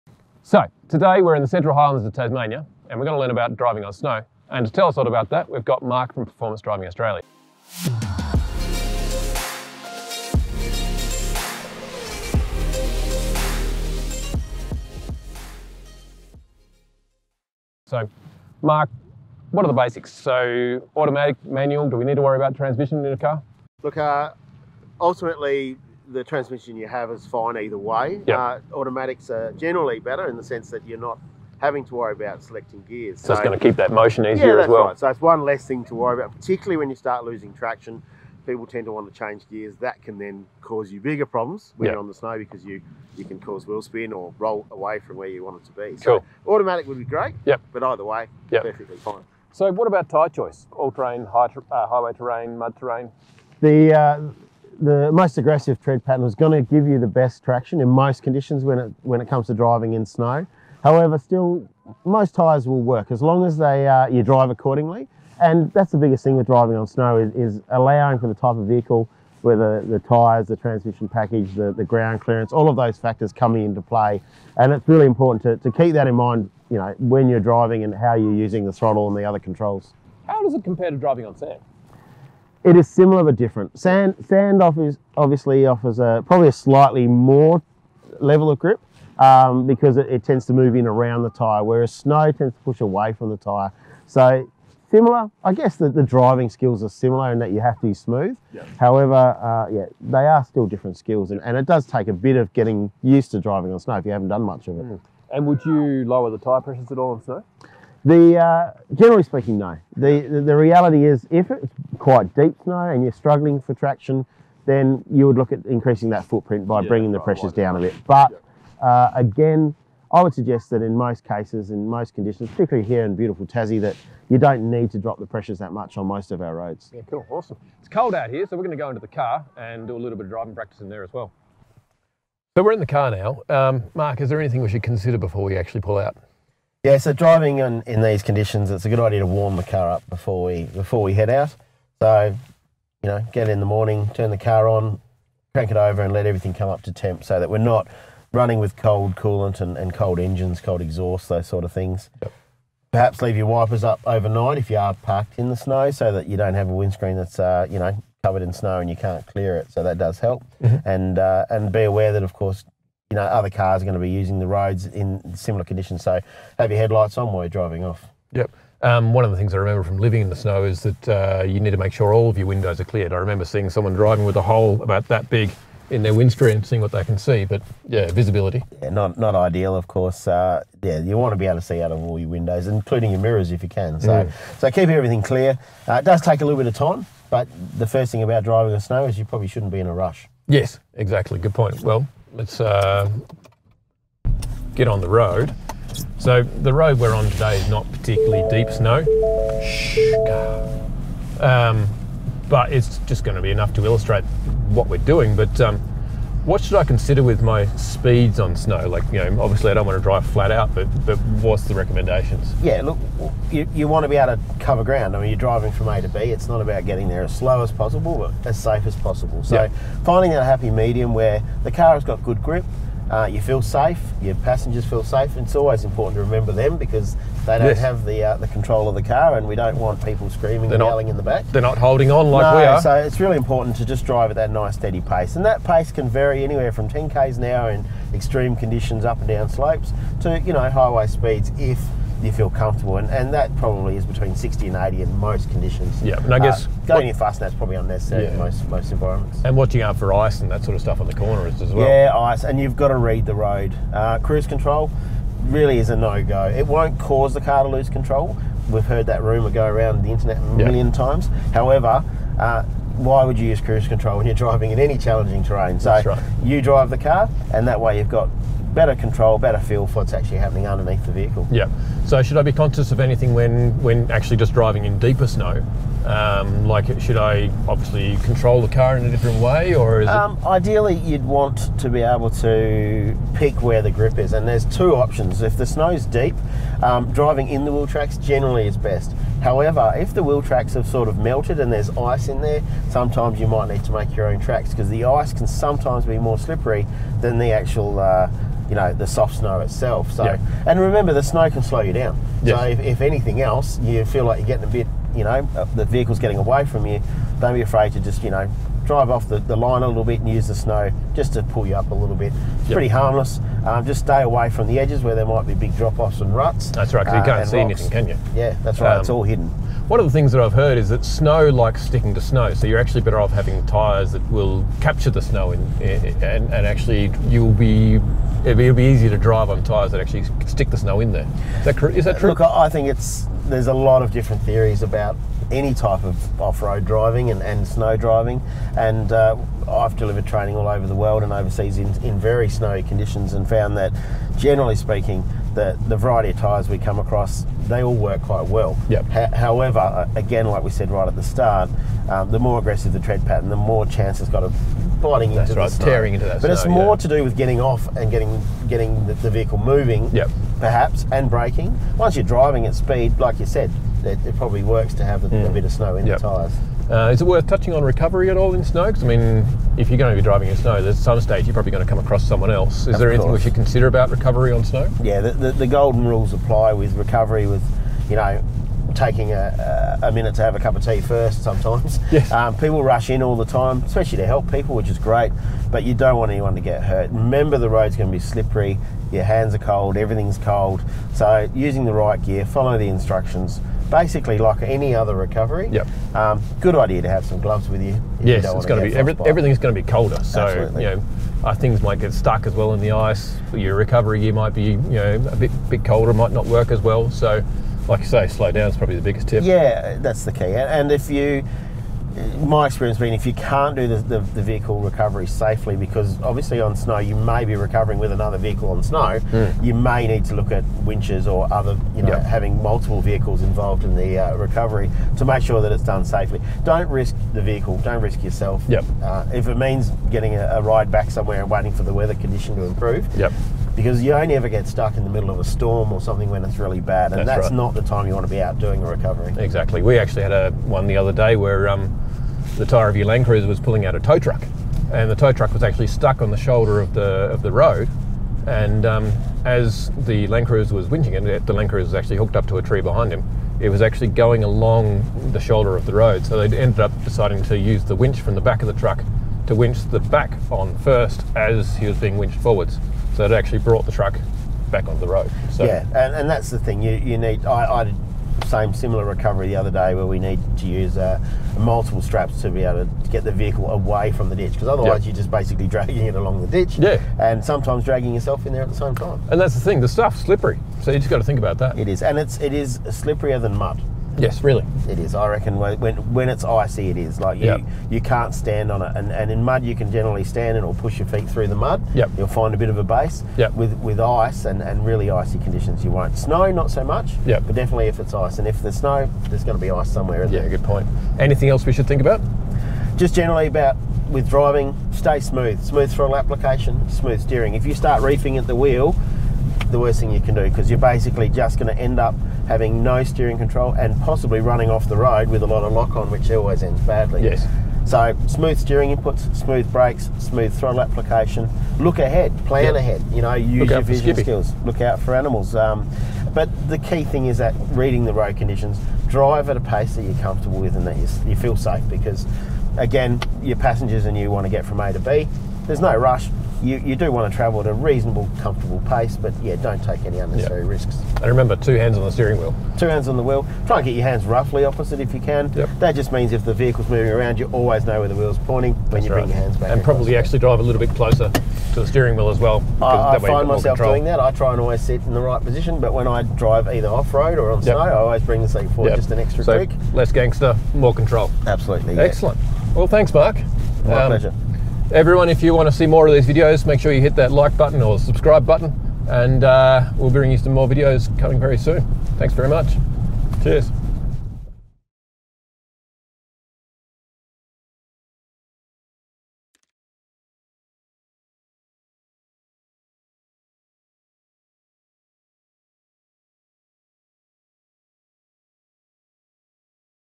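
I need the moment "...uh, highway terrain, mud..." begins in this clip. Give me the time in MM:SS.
00:51.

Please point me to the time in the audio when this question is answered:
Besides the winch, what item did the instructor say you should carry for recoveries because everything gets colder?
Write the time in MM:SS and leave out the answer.
06:37.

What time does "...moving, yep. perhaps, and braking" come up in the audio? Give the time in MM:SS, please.
05:59.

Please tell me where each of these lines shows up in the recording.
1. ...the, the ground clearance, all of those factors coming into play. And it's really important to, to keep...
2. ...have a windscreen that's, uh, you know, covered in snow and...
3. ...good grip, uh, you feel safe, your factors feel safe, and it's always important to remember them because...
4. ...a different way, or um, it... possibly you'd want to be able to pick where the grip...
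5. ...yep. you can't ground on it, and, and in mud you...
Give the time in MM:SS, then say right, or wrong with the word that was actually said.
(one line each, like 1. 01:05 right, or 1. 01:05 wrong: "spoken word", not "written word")
1. 01:11 right
2. 02:36 right
3. 03:42 wrong: "passengers", not "factors"
4. 04:39 wrong: "ideally", not "possibly"
5. 08:07 wrong: "stand", not "ground".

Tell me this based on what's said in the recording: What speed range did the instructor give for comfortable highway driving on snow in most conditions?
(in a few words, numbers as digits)
60 to 80.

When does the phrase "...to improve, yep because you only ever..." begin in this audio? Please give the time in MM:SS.
07:12.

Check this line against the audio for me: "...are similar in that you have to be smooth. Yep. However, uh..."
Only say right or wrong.
right.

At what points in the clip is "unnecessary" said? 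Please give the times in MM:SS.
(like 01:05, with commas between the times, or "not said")
04:07, 09:00.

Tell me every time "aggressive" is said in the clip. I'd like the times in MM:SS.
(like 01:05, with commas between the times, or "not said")
00:55, 05:52.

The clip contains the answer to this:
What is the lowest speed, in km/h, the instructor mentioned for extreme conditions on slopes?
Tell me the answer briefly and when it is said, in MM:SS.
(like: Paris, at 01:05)
10, at 03:56.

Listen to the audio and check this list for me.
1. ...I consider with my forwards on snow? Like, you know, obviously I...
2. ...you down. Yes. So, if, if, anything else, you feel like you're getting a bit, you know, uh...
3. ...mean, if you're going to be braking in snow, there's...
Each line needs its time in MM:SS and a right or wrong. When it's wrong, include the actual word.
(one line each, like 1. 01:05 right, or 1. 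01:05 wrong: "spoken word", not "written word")
1. 03:26 wrong: "speeds", not "forwards"
2. 05:01 right
3. 06:09 wrong: "driving", not "braking".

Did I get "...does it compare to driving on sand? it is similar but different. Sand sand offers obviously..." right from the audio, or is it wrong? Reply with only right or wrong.
right.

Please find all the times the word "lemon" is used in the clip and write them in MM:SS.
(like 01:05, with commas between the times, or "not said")
not said.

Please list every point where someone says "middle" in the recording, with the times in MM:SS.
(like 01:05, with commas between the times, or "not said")
07:15.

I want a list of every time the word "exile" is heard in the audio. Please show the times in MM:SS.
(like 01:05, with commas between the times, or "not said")
not said.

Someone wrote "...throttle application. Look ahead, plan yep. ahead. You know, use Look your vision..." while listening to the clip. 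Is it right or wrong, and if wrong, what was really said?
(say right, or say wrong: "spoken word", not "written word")
right.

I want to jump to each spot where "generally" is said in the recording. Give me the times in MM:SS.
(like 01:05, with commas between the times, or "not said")
00:29, 01:48, 04:48, 05:44, 08:09, 08:23.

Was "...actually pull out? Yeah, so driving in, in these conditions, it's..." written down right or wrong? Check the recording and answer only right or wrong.
right.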